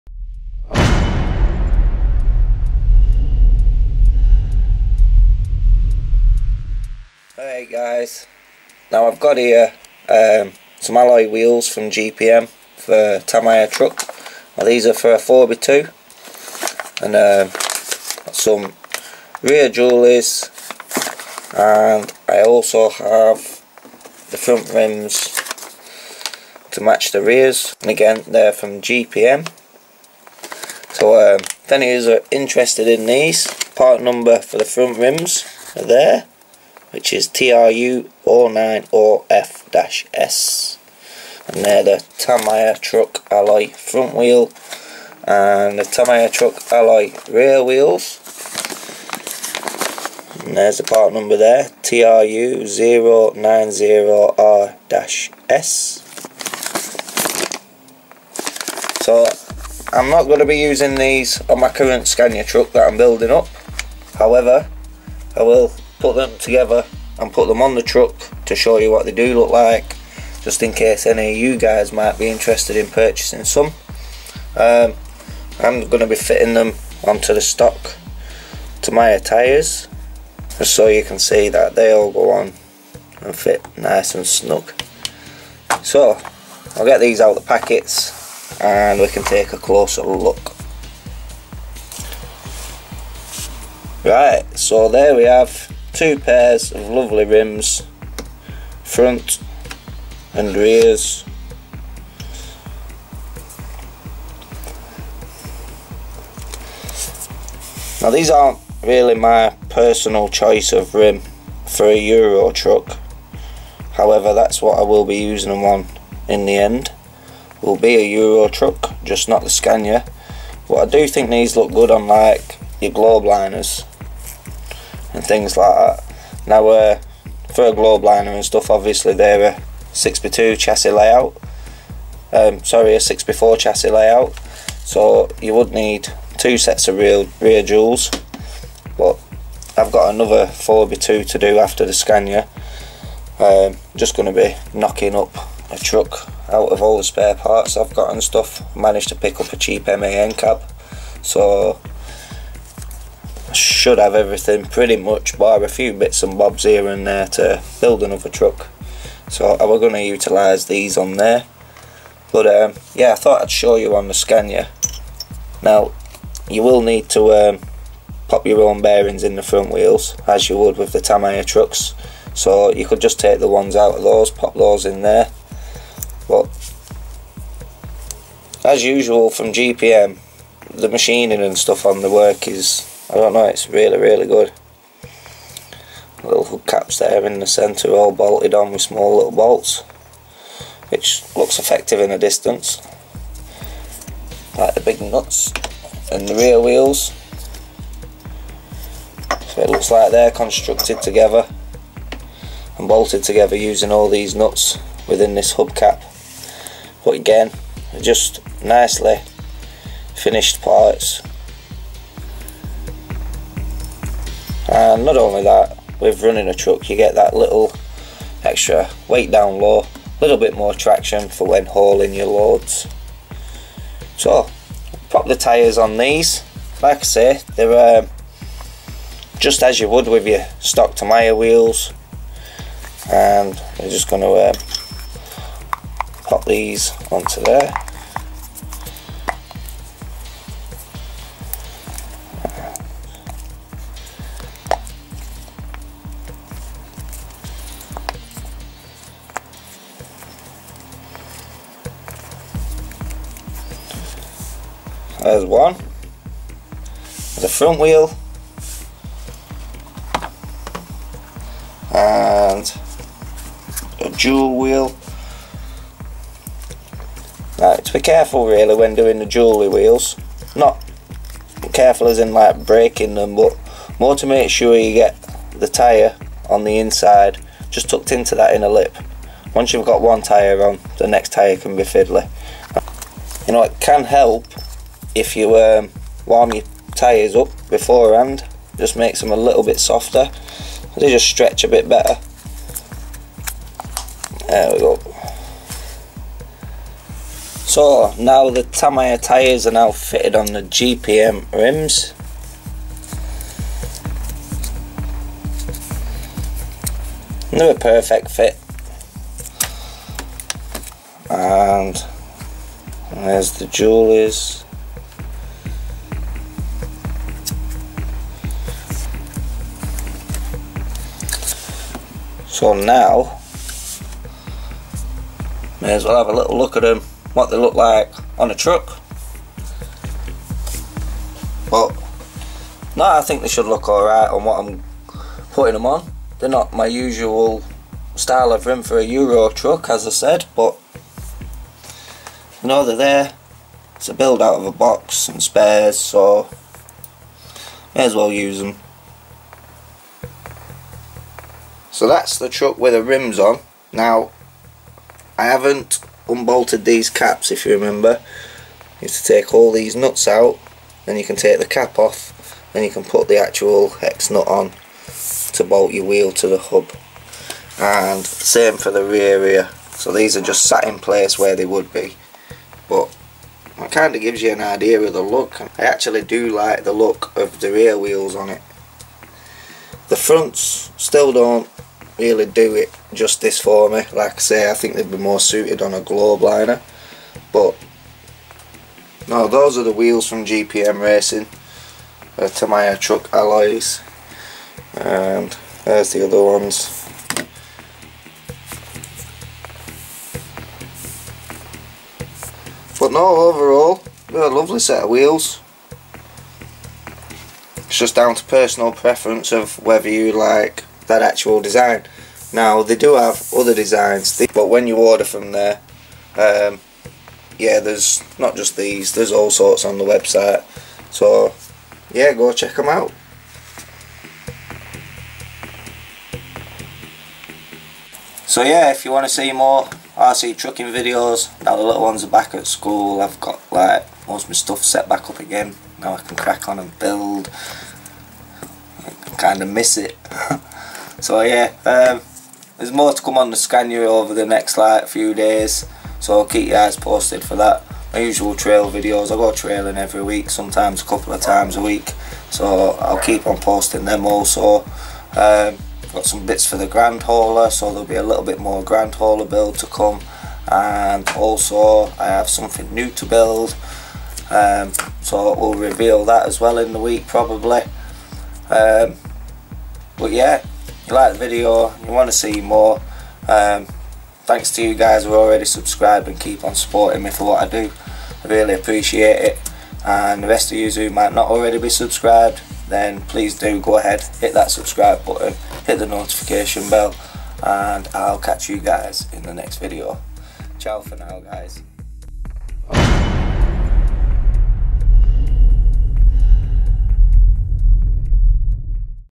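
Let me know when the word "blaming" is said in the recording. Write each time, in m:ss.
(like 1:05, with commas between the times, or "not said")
not said.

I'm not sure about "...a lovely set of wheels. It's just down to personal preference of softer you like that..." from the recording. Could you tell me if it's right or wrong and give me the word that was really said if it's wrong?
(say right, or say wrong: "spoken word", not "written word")
wrong: "whether", not "softer".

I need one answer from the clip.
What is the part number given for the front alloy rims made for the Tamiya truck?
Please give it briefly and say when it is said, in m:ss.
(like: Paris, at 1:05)
TRU09OF-S, at 0:37.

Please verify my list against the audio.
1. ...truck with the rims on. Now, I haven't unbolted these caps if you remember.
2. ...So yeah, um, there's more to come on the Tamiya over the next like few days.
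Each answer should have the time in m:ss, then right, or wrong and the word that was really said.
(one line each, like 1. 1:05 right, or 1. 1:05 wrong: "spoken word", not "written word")
1. 5:52 right
2. 7:21 wrong: "Scania", not "Tamiya".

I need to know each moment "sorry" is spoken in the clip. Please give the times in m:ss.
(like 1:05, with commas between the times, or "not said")
2:12.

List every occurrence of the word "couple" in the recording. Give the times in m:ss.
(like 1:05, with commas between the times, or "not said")
7:31.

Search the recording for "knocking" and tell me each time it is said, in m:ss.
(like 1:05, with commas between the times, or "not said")
2:24.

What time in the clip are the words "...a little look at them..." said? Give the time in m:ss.
5:26.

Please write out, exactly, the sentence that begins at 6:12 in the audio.
But it kind of gives you an idea of the look.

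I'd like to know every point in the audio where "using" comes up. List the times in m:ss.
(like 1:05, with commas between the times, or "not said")
1:00, 1:55, 3:23.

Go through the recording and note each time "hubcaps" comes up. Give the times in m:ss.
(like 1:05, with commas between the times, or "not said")
3:06, 3:25.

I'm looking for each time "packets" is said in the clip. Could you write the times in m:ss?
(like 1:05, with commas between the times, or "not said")
1:27.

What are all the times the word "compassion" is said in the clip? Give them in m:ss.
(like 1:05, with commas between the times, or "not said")
not said.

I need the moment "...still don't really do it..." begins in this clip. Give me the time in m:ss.
6:20.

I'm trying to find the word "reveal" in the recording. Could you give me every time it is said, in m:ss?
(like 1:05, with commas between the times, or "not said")
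7:45.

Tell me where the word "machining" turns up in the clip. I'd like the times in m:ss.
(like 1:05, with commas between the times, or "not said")
3:00.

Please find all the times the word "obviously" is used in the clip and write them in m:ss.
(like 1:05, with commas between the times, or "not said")
2:08.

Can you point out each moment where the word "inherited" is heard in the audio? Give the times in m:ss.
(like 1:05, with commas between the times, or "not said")
not said.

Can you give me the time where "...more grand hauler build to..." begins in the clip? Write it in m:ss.
7:38.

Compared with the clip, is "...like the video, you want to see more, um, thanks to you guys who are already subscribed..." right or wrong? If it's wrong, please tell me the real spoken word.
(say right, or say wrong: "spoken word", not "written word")
right.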